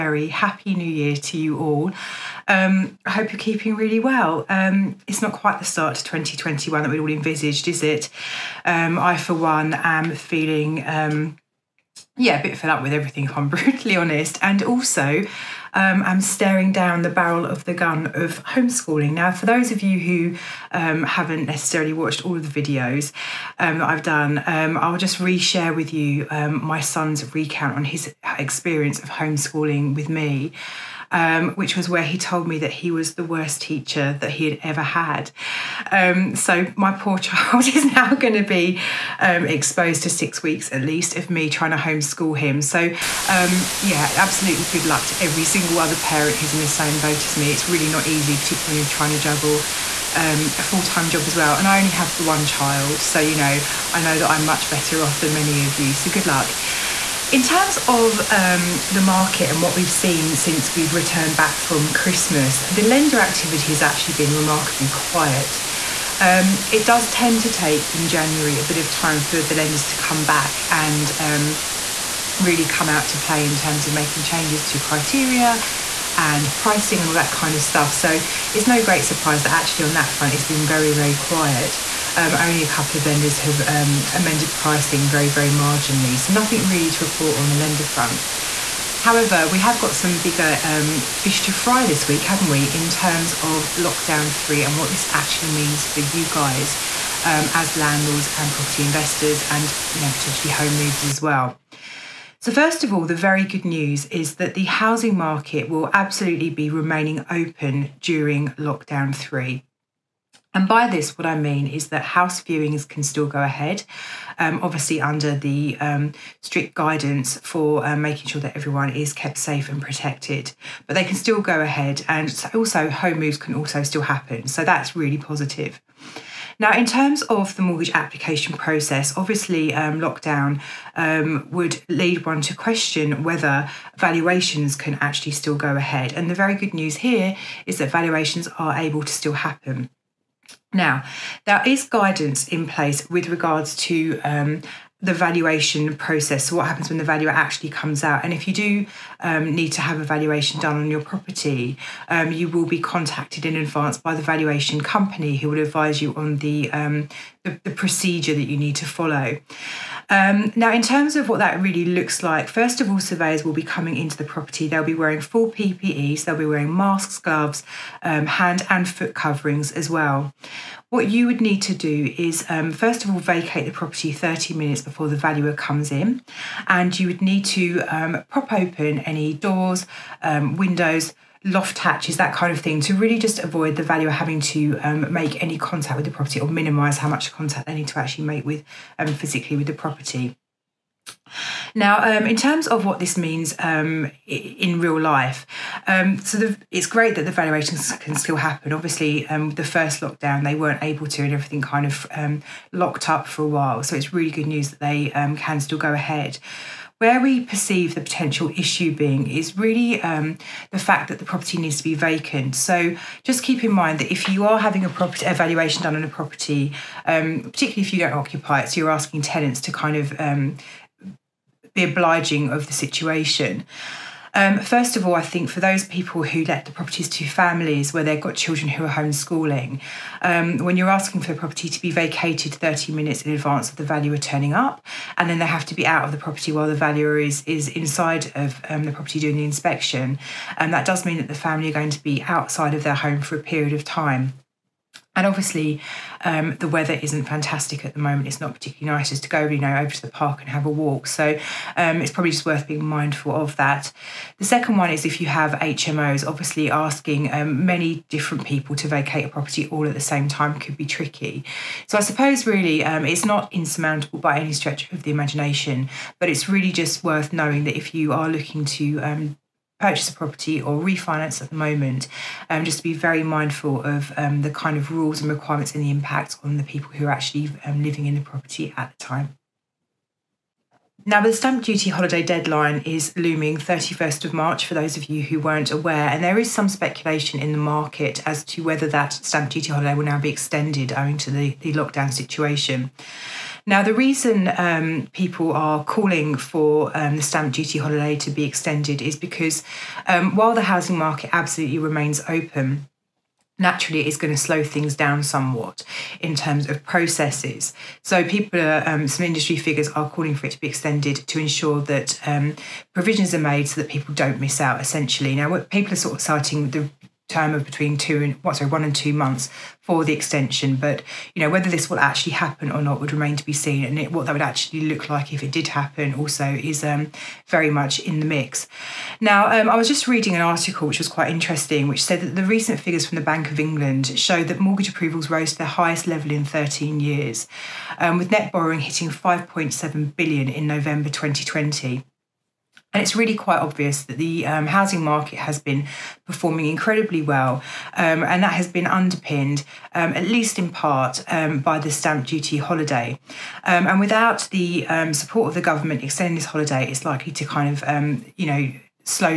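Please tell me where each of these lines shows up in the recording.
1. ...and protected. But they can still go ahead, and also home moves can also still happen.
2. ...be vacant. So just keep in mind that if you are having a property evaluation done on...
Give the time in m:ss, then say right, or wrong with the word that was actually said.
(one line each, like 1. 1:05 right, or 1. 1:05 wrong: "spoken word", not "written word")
1. 1:59 right
2. 3:31 right.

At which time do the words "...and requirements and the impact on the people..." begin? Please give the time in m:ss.
4:35.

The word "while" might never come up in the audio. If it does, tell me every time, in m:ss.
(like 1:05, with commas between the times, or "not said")
3:23, 3:56, 5:00.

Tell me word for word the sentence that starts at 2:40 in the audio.
Um, now, in terms of what that really looks like, first of all, surveyors will be coming into the property.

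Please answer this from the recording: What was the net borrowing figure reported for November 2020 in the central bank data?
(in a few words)
5.7 billion.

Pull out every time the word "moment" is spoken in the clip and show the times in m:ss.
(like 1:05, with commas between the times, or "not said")
4:07, 4:31.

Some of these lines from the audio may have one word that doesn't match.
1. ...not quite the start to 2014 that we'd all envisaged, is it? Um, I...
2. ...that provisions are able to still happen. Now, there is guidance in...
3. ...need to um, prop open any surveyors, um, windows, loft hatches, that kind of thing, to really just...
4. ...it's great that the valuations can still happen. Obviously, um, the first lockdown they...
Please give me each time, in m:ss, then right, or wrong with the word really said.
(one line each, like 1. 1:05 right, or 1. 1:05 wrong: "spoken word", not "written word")
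1. 0:05 wrong: "2021", not "2014"
2. 2:17 wrong: "valuations", not "provisions"
3. 2:57 wrong: "doors", not "surveyors"
4. 3:16 right.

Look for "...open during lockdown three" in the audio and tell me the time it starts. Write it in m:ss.
1:47.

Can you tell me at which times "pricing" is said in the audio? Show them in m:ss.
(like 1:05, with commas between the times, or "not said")
1:16, 1:24.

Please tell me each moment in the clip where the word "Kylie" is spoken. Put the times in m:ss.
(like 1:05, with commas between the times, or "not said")
not said.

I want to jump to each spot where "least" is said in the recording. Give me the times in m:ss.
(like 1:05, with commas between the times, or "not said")
0:40, 5:50.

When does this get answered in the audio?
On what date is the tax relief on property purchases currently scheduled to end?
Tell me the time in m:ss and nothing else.
4:43.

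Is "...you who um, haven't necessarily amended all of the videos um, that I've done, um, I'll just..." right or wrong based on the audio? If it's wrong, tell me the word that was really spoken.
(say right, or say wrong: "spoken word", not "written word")
wrong: "watched", not "amended".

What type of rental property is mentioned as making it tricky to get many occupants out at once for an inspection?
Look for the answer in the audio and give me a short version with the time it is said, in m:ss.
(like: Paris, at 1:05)
HMOs, at 4:15.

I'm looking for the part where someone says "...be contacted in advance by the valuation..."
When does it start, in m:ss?
2:32.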